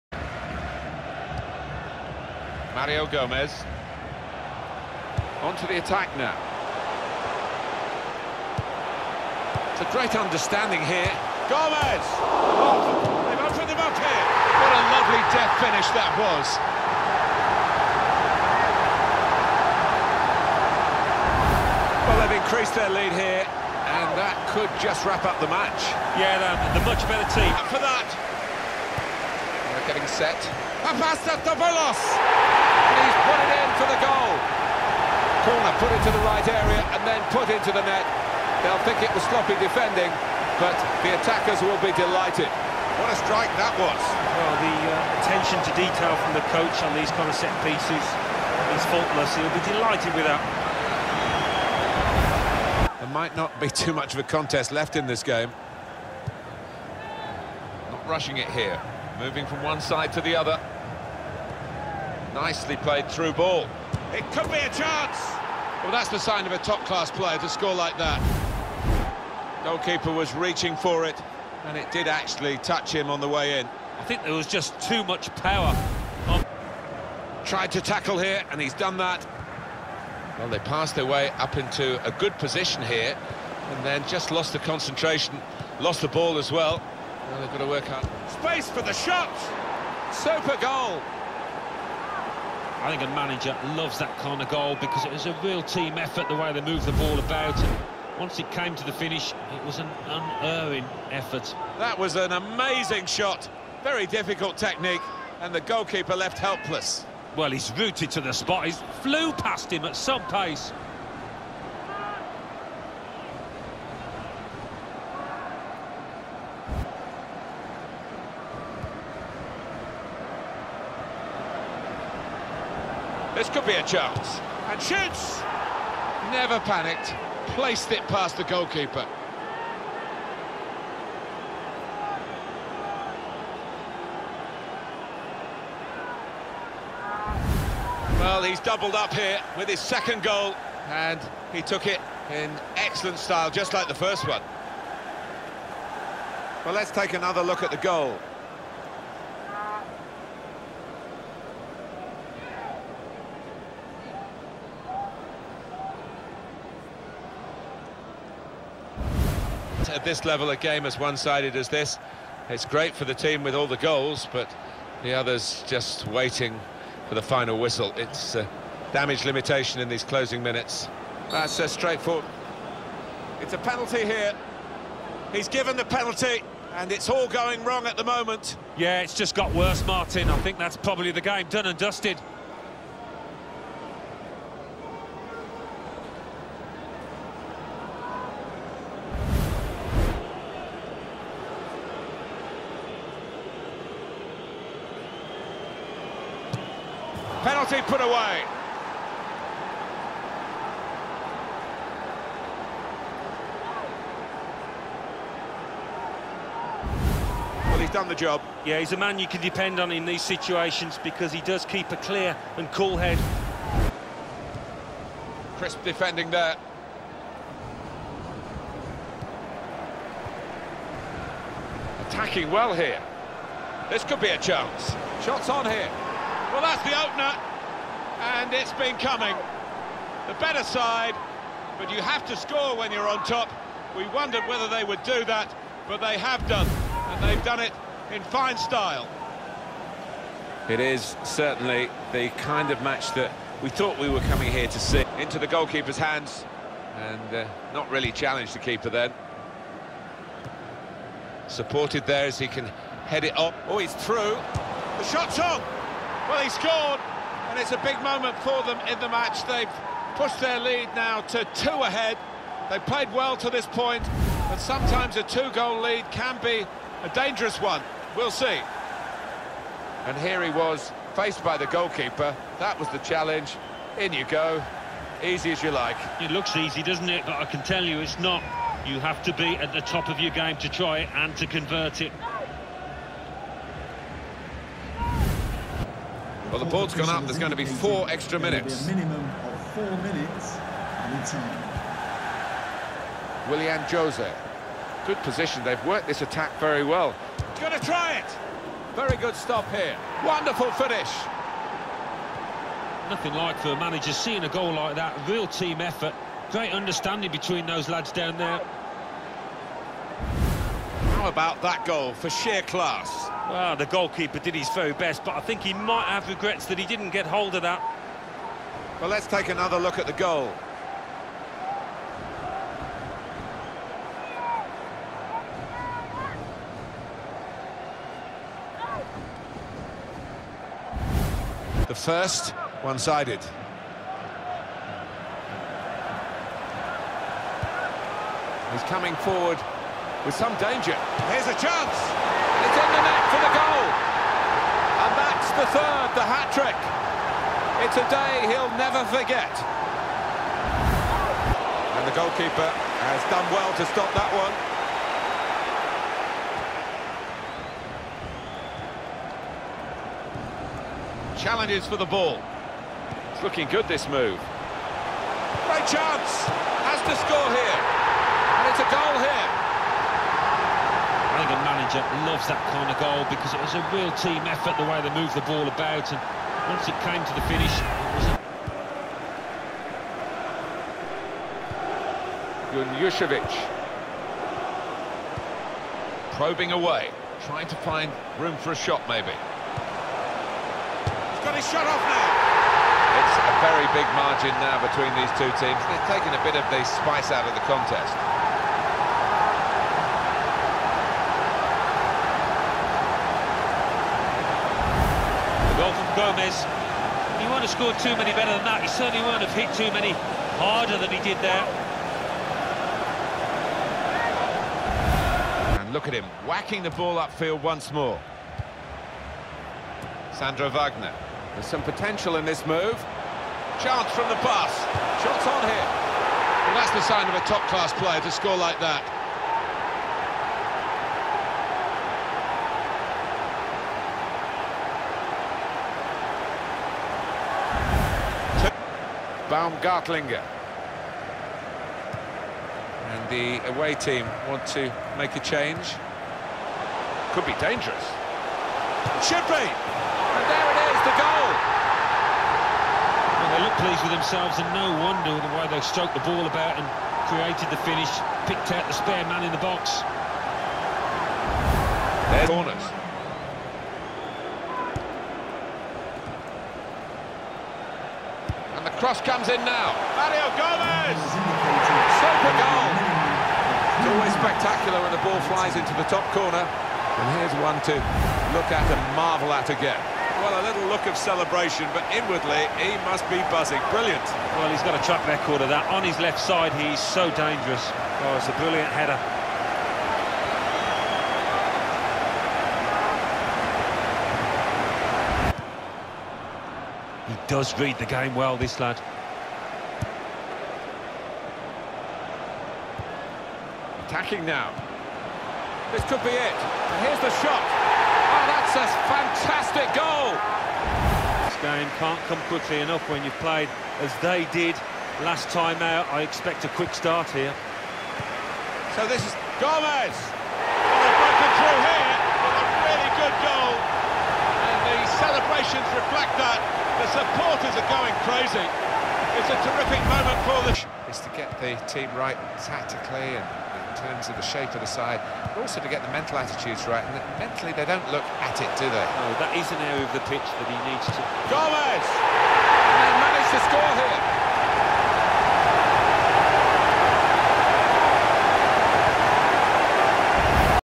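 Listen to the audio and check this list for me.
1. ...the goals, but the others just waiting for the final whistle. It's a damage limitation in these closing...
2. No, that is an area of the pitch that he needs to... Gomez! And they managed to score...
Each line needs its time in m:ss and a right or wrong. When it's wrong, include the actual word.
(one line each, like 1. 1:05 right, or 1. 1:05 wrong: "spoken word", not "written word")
1. 2:43 right
2. 8:59 right.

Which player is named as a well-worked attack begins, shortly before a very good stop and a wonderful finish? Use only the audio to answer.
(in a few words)
Willian Jose.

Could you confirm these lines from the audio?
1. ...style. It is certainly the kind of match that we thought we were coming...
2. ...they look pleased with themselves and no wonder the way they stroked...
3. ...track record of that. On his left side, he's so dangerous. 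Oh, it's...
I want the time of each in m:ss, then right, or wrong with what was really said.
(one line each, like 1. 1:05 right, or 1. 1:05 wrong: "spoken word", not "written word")
1. 3:58 right
2. 7:33 right
3. 8:05 right.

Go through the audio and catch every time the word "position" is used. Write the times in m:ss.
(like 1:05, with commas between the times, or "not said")
1:22, 4:55.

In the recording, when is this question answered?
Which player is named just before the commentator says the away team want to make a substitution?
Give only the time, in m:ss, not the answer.
7:19.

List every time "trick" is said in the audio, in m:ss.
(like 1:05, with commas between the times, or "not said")
5:46.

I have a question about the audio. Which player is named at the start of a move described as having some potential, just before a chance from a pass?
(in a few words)
Sandro Wagner.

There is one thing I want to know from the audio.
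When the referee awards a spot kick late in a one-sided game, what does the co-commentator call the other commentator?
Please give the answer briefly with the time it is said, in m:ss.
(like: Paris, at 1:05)
Martin, at 2:59.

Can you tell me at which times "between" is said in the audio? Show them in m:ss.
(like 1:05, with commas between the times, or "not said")
5:07, 6:34.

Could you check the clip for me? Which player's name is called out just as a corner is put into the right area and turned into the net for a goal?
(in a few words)
Papastathopoulos.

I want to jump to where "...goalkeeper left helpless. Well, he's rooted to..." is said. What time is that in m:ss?
1:45.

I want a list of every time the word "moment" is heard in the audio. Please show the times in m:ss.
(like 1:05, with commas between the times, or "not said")
2:58, 4:18, 8:50.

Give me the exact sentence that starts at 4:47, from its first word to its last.
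There's going to be four extra minutes.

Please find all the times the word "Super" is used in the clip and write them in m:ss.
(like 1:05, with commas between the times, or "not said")
1:30, 7:52.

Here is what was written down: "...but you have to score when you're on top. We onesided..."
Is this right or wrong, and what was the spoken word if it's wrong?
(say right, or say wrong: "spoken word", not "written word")
wrong: "wondered", not "onesided".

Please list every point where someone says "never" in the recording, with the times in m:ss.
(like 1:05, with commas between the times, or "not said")
2:06, 5:48.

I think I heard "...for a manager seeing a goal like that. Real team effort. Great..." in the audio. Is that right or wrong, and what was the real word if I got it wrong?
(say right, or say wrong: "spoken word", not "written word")
right.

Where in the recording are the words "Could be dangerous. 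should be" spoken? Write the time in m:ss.
7:27.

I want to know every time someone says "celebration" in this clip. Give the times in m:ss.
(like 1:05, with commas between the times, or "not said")
8:01, 8:45.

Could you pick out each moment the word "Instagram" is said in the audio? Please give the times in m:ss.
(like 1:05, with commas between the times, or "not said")
not said.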